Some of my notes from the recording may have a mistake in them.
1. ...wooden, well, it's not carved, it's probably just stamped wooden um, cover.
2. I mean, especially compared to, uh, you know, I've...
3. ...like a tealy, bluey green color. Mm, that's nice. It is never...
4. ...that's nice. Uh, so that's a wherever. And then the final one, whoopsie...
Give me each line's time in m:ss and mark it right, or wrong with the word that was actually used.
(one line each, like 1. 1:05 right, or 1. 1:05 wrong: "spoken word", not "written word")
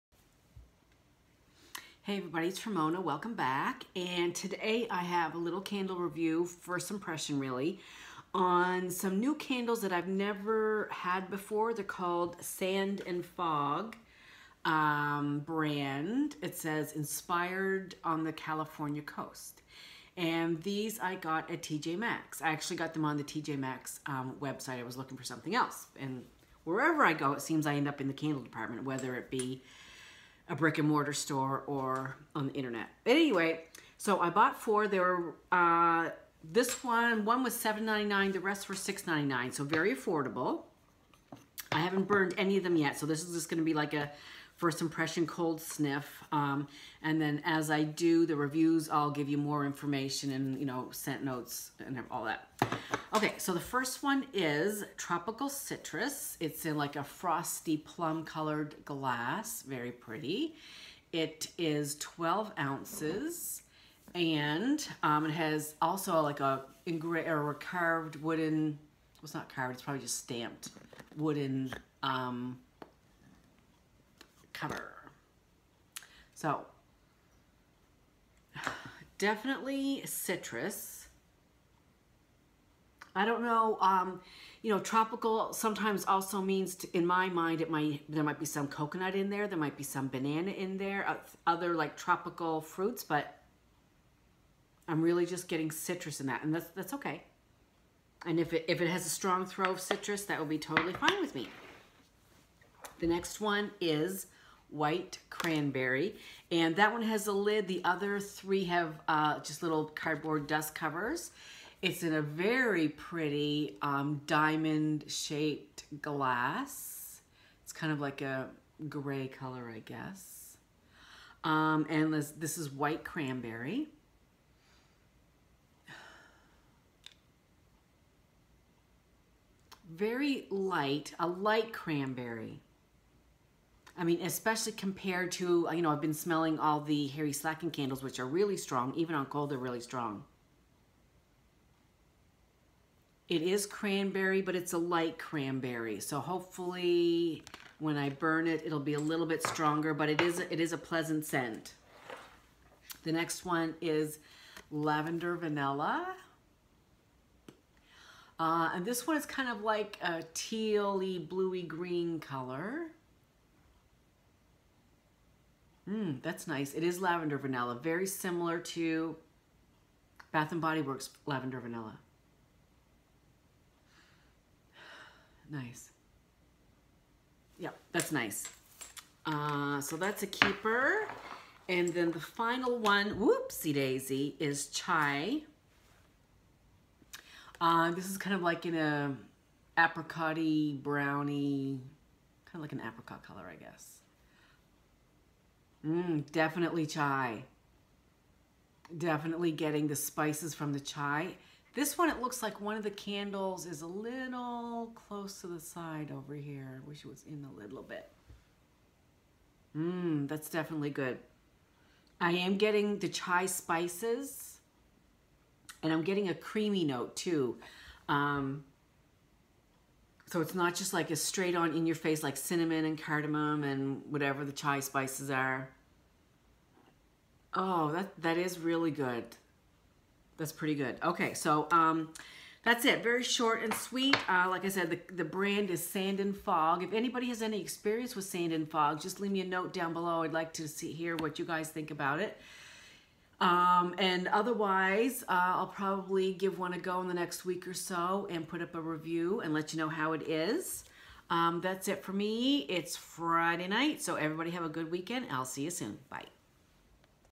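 1. 1:08 right
2. 2:14 right
3. 2:39 wrong: "lavender", not "never"
4. 2:57 wrong: "keeper", not "wherever".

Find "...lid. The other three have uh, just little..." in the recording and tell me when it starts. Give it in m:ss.
1:47.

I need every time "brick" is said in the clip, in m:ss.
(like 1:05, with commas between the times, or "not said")
0:30.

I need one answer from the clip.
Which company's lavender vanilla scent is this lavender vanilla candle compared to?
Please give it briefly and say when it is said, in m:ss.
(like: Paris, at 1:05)
Bath and Body Works, at 2:50.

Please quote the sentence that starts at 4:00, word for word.
I'd like to see hear what you guys think about it.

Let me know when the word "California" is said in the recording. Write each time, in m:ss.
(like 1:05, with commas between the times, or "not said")
0:18.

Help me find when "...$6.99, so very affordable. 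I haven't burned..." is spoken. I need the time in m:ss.
0:38.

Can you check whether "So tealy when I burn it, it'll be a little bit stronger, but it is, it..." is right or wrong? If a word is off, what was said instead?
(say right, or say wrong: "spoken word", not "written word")
wrong: "hopefully", not "tealy".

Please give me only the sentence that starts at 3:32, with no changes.
I am getting the chai spices and I'm getting a creamy note too.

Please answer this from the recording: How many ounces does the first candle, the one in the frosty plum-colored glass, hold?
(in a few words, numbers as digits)
12.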